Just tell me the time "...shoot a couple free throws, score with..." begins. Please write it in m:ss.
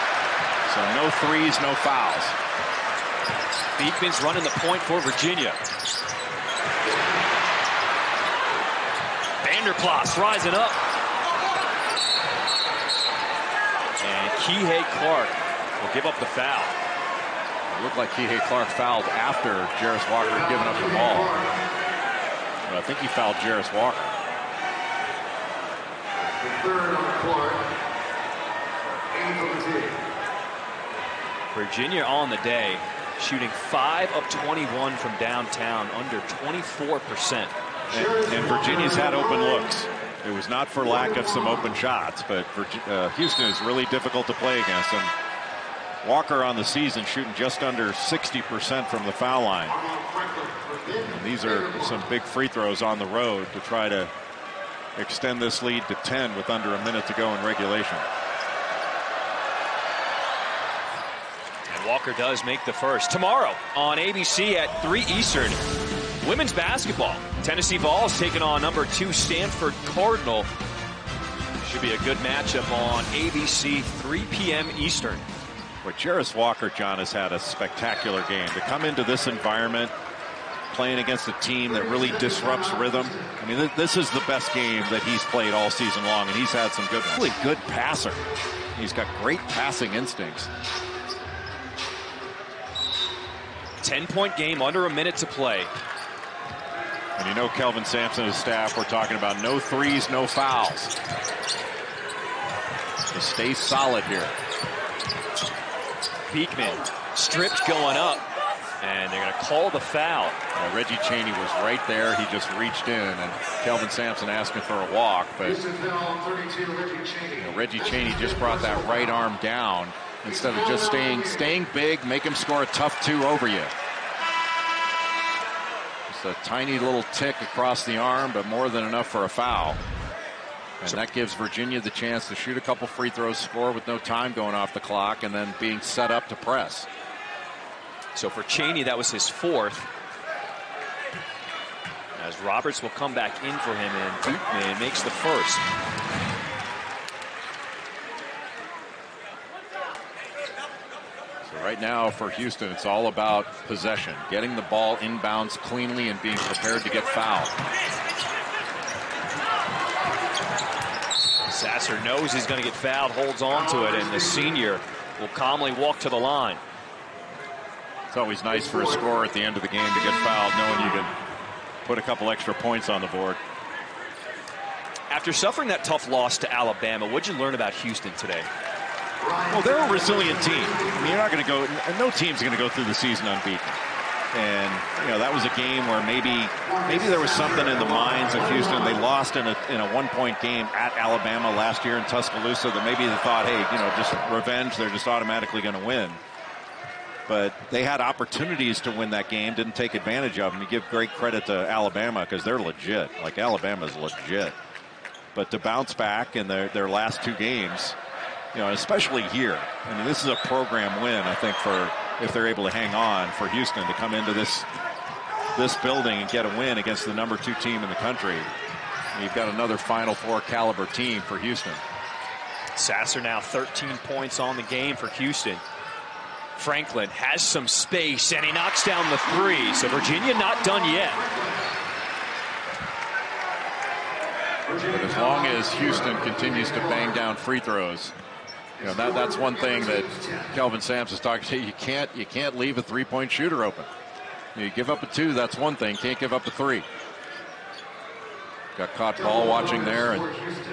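2:12.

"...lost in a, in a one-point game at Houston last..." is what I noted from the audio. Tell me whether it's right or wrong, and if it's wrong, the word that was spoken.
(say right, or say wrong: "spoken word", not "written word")
wrong: "Alabama", not "Houston".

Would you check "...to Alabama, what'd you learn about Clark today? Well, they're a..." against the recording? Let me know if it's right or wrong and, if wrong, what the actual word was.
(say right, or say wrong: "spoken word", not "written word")
wrong: "Houston", not "Clark".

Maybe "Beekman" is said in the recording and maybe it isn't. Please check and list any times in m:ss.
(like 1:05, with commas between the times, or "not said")
0:03, 1:46.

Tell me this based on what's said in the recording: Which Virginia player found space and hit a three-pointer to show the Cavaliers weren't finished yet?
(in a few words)
Franklin.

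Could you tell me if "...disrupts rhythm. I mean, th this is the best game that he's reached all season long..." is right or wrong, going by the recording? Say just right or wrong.
wrong.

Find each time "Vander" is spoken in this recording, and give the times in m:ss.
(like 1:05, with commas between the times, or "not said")
0:09.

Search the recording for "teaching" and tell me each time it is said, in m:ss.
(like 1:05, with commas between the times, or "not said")
not said.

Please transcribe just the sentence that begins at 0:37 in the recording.
And, and Virginia's had open looks.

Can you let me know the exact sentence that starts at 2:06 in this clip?
Just a tiny little tick across the arm, but more than enough for a foul.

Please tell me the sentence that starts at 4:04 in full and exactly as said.
You give up a two, that's one thing.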